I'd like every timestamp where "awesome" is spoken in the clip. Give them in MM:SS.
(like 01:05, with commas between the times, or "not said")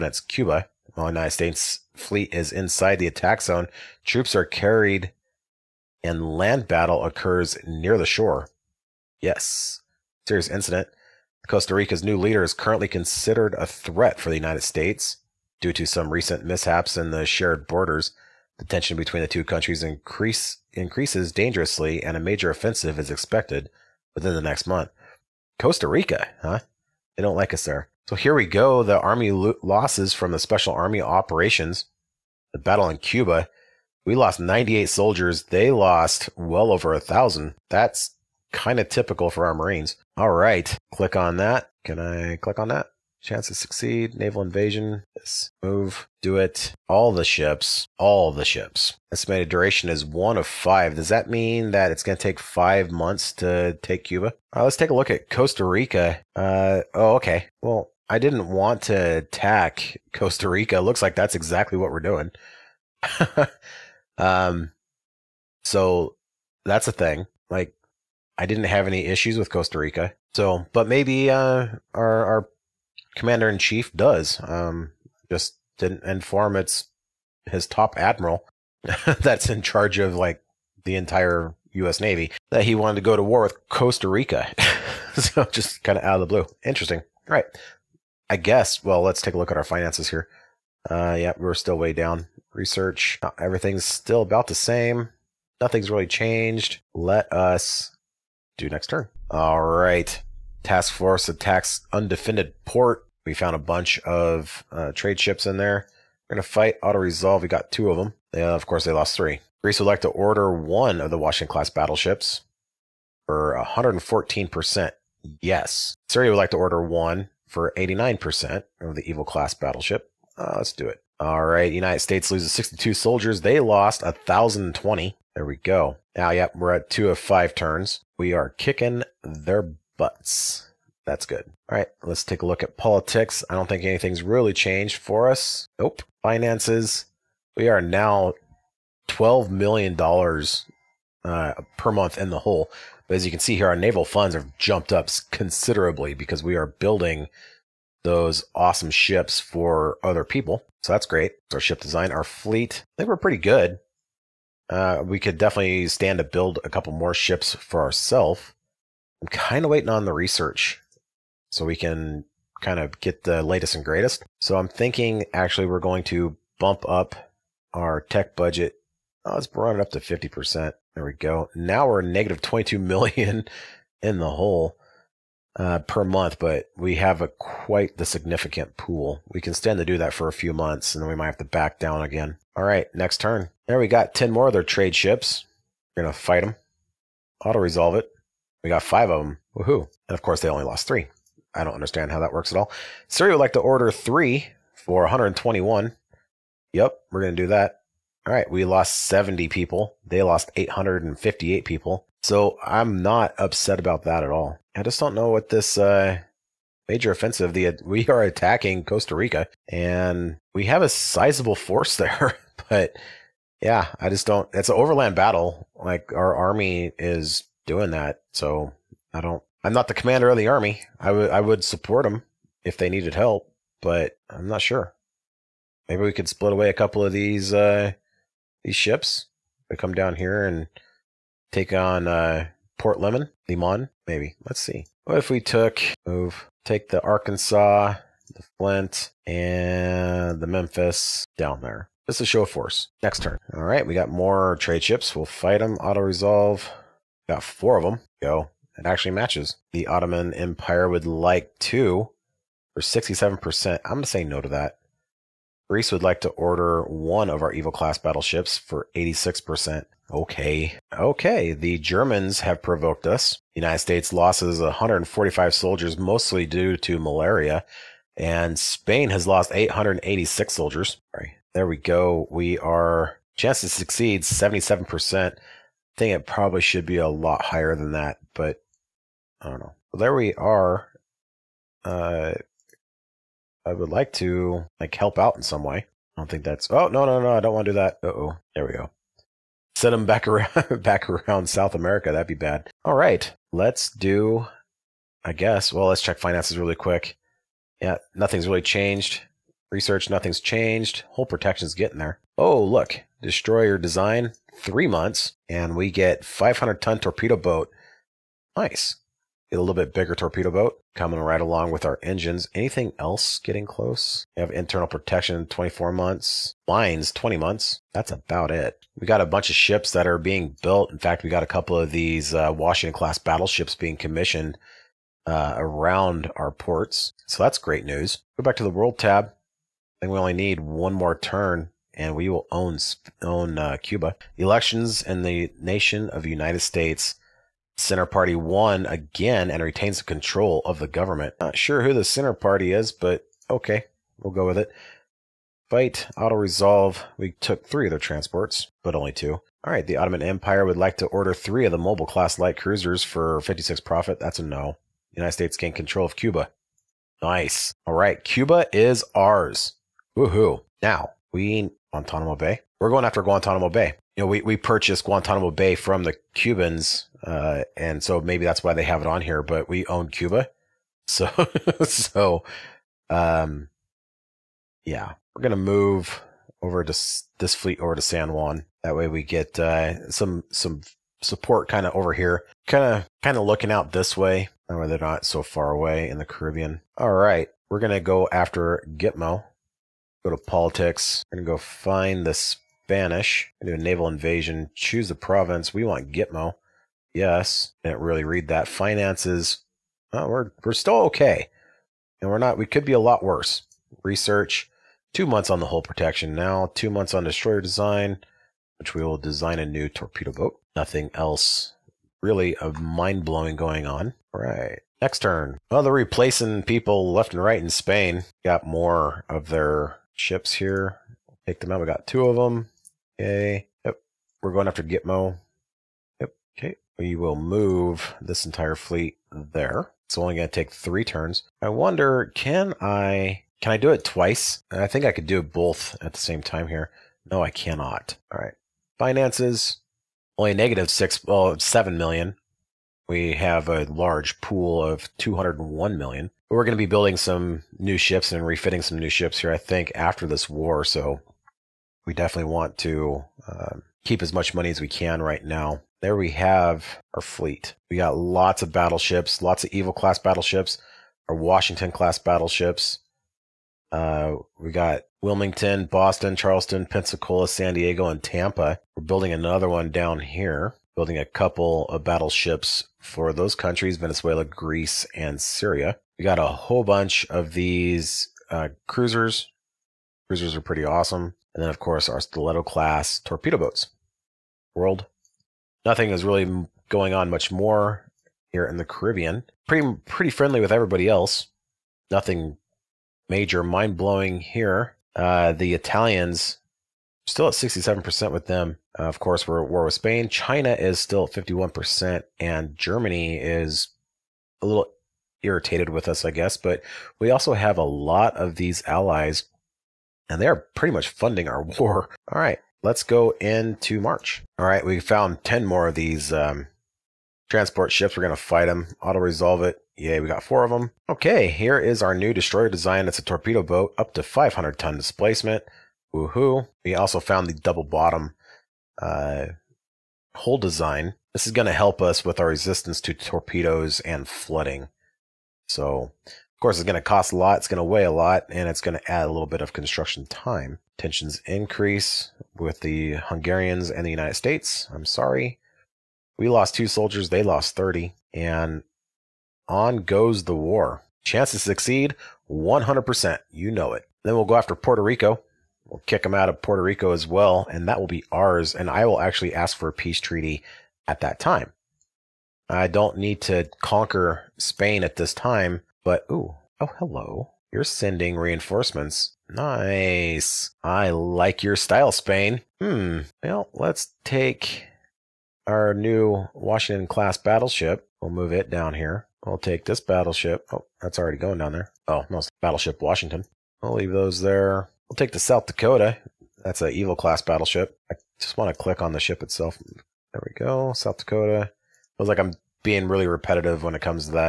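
02:28, 08:00.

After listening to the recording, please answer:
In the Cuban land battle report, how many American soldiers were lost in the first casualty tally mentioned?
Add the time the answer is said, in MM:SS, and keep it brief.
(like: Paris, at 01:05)
98, at 00:34.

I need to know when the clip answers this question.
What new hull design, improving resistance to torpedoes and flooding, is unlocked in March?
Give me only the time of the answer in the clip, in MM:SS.
08:47.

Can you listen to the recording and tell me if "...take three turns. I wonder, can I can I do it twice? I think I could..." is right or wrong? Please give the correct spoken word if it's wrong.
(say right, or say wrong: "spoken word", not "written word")
right.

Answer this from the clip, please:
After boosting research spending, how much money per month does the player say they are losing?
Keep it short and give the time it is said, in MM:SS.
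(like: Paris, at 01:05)
22 million, at 02:52.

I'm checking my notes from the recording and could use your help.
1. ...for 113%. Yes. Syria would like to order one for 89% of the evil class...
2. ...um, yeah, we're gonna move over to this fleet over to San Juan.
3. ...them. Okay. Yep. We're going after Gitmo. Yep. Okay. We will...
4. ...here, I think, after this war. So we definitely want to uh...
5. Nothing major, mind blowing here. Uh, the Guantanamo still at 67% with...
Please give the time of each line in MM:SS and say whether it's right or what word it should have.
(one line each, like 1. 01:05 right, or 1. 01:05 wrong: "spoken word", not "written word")
1. 01:53 wrong: "114", not "113"
2. 06:13 right
3. 07:02 right
4. 07:29 right
5. 08:12 wrong: "Italians", not "Guantanamo".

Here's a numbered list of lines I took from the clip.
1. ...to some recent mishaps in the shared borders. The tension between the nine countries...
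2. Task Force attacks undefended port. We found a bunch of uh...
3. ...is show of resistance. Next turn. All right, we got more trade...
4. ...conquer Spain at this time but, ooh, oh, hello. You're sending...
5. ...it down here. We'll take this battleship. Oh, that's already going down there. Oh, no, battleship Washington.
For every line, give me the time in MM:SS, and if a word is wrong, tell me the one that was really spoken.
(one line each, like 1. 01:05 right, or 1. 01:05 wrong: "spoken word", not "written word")
1. 00:15 wrong: "two", not "nine"
2. 01:40 right
3. 04:02 wrong: "force", not "resistance"
4. 09:23 right
5. 09:38 right.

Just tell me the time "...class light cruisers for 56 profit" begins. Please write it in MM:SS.
05:52.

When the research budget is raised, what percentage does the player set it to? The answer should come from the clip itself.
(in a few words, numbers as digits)
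50%.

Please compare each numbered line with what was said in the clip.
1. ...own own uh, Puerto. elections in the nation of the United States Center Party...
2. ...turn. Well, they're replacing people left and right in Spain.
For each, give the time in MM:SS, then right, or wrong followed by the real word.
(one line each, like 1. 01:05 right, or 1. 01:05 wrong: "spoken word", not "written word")
1. 05:32 wrong: "Cuba", not "Puerto"
2. 06:55 right.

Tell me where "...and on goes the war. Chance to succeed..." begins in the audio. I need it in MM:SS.
09:08.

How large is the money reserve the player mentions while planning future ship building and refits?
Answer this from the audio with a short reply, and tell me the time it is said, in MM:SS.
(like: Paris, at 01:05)
201 million, at 07:25.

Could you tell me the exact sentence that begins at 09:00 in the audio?
Tensions increase with the Hungarians and the United States.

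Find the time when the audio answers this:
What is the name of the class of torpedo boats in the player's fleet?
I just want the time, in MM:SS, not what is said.
08:02.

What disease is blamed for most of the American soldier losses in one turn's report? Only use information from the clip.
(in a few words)
Malaria.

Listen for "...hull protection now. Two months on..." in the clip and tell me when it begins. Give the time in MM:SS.
06:45.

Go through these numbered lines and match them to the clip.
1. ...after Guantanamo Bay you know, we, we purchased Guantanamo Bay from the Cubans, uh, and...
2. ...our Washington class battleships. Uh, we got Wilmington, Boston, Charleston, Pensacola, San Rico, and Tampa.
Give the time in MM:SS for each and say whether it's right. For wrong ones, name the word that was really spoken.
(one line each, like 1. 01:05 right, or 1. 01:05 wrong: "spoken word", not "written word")
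1. 06:03 right
2. 07:41 wrong: "Diego", not "Rico".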